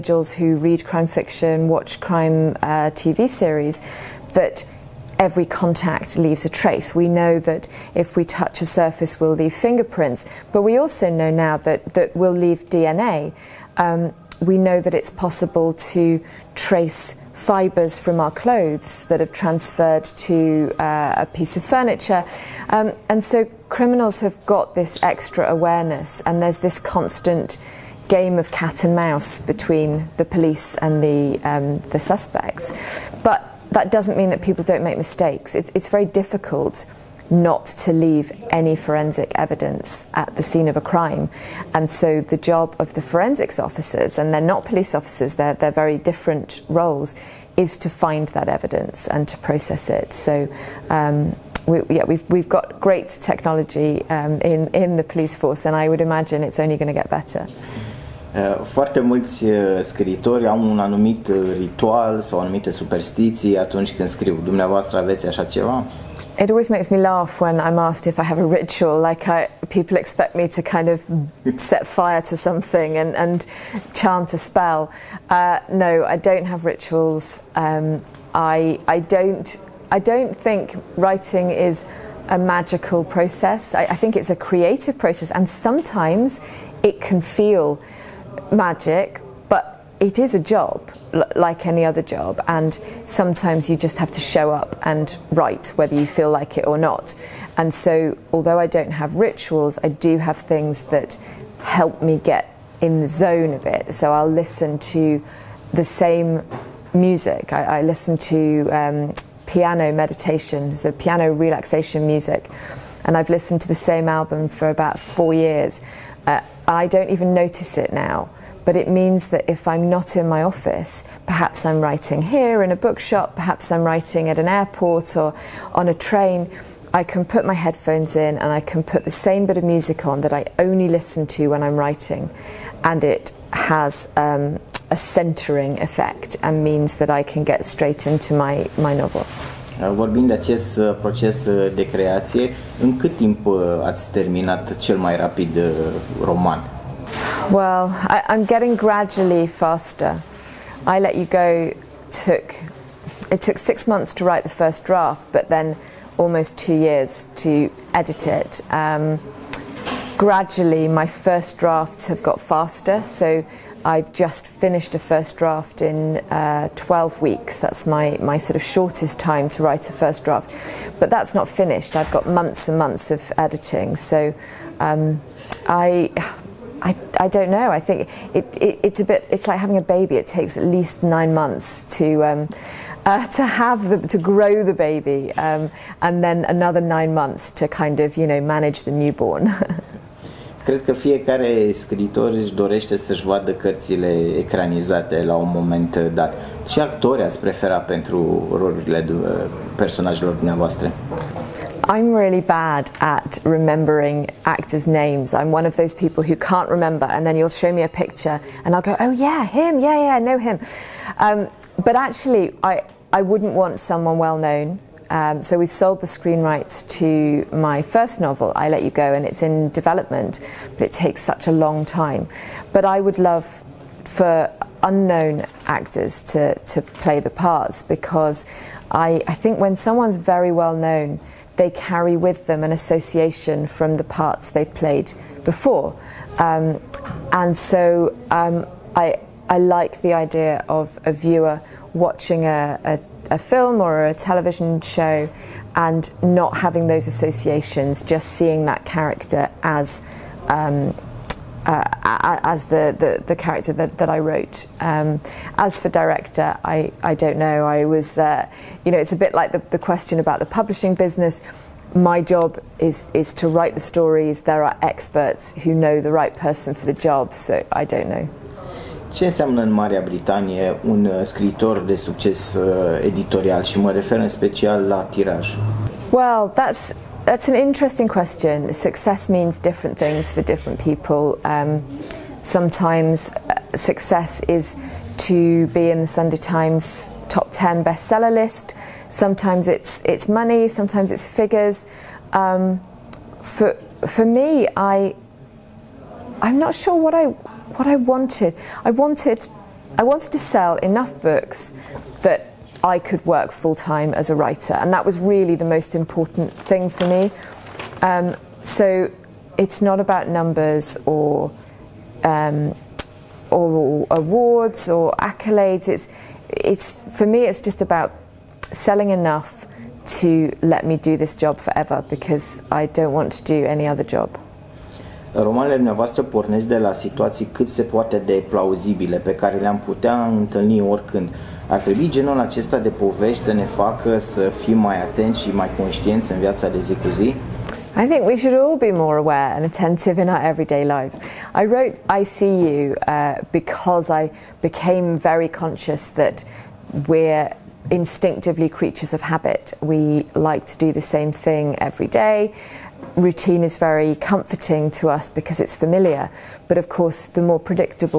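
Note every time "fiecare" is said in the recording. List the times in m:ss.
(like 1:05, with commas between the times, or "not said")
3:10.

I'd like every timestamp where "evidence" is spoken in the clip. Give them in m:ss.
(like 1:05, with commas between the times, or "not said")
0:39, 0:48.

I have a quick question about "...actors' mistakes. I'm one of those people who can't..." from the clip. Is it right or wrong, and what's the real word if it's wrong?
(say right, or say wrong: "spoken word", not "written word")
wrong: "names", not "mistakes".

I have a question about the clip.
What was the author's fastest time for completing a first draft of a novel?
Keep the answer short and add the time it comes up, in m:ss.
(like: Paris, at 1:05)
12 weeks, at 2:46.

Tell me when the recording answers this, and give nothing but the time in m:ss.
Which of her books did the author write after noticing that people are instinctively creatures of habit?
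5:42.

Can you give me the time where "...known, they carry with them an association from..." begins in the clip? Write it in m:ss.
3:50.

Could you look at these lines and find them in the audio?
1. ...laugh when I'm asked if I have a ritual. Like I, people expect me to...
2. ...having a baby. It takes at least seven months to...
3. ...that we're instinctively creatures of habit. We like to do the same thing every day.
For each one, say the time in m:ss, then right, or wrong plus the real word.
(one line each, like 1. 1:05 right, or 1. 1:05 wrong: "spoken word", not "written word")
1. 1:06 right
2. 2:59 wrong: "nine", not "seven"
3. 5:46 right.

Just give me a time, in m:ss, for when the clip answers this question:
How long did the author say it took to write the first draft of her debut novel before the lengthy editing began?
2:33.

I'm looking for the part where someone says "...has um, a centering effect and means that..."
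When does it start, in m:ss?
2:13.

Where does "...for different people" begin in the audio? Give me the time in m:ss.
4:40.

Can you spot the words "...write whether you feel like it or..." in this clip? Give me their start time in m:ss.
1:35.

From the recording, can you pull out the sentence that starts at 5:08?
Um, so it's not about numbers or, um, or, awards or accolades.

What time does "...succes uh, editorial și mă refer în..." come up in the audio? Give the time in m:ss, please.
4:31.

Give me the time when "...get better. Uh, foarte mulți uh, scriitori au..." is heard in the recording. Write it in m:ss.
0:56.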